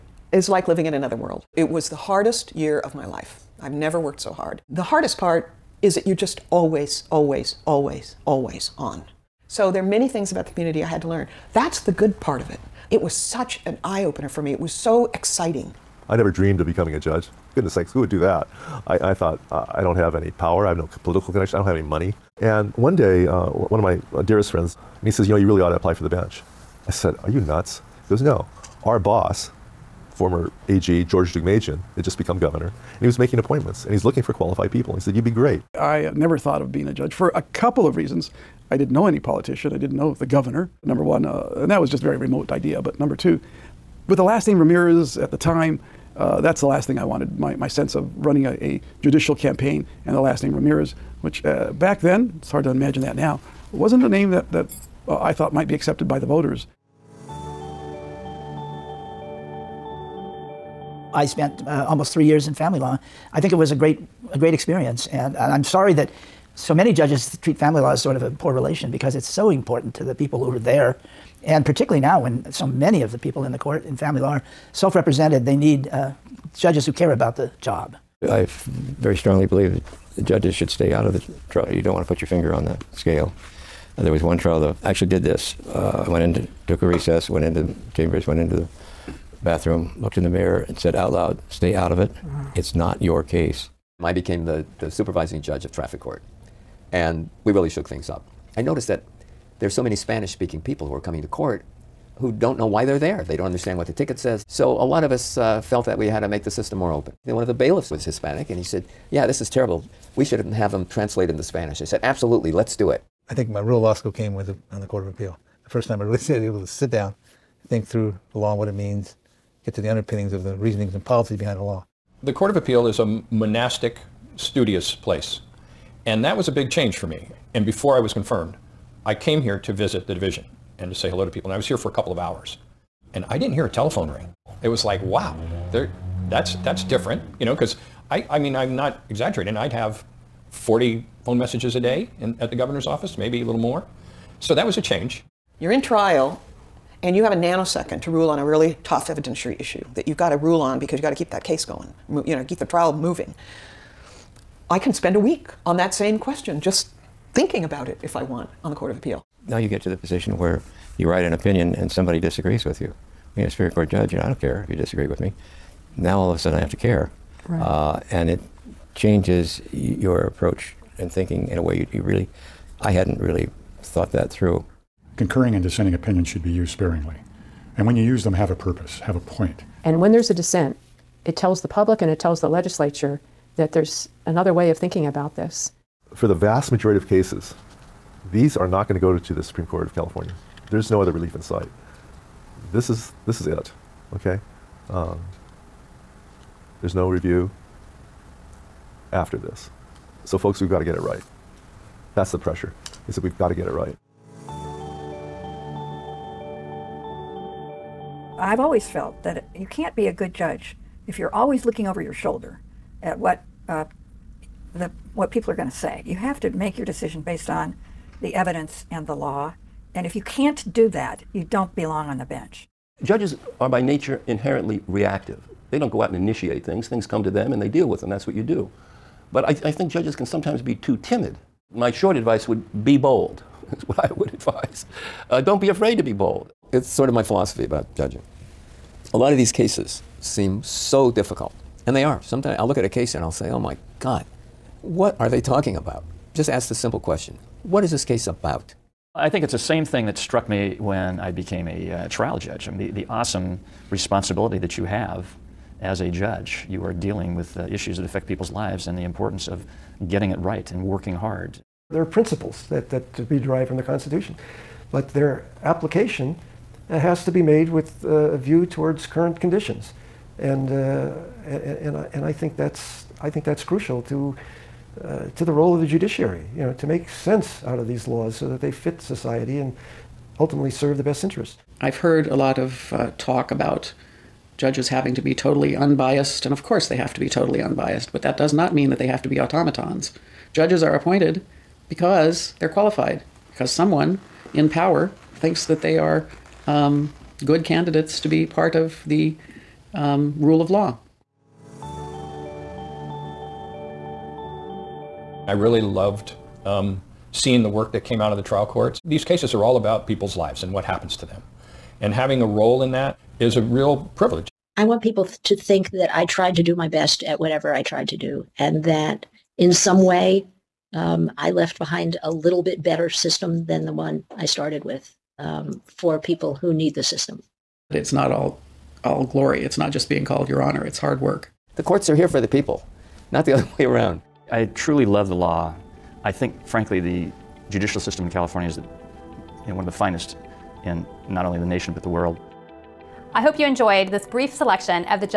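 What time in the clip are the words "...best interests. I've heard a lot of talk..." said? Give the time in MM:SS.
04:41.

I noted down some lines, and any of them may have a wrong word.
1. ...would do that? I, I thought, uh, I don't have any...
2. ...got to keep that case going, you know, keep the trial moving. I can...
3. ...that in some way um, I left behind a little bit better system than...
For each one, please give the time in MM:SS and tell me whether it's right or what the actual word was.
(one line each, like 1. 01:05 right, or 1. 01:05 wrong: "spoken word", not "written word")
1. 00:18 right
2. 02:31 right
3. 05:18 right.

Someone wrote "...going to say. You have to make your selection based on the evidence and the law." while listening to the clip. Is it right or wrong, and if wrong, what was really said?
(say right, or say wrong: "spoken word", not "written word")
wrong: "decision", not "selection".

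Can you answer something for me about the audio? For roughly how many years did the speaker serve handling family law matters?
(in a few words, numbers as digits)
3.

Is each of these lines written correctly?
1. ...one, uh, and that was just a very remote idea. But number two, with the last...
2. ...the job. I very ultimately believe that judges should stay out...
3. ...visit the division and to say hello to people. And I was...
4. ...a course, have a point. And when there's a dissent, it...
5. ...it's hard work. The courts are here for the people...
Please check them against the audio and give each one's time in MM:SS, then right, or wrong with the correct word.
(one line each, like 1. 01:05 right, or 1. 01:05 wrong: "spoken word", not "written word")
1. 00:41 right
2. 01:17 wrong: "strongly", not "ultimately"
3. 02:09 right
4. 02:58 wrong: "purpose", not "course"
5. 05:30 right.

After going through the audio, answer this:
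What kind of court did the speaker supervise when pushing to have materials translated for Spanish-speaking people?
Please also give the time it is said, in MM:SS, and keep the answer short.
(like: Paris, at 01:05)
Traffic court, at 01:35.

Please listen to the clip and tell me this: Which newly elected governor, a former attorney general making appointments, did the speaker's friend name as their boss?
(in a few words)
George Deukmejian.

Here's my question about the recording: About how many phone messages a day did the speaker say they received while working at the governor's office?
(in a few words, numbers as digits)
40.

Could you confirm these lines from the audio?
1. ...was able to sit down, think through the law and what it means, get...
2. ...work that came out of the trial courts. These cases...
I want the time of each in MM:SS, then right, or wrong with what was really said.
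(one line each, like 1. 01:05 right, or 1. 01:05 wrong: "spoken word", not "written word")
1. 01:56 right
2. 05:07 right.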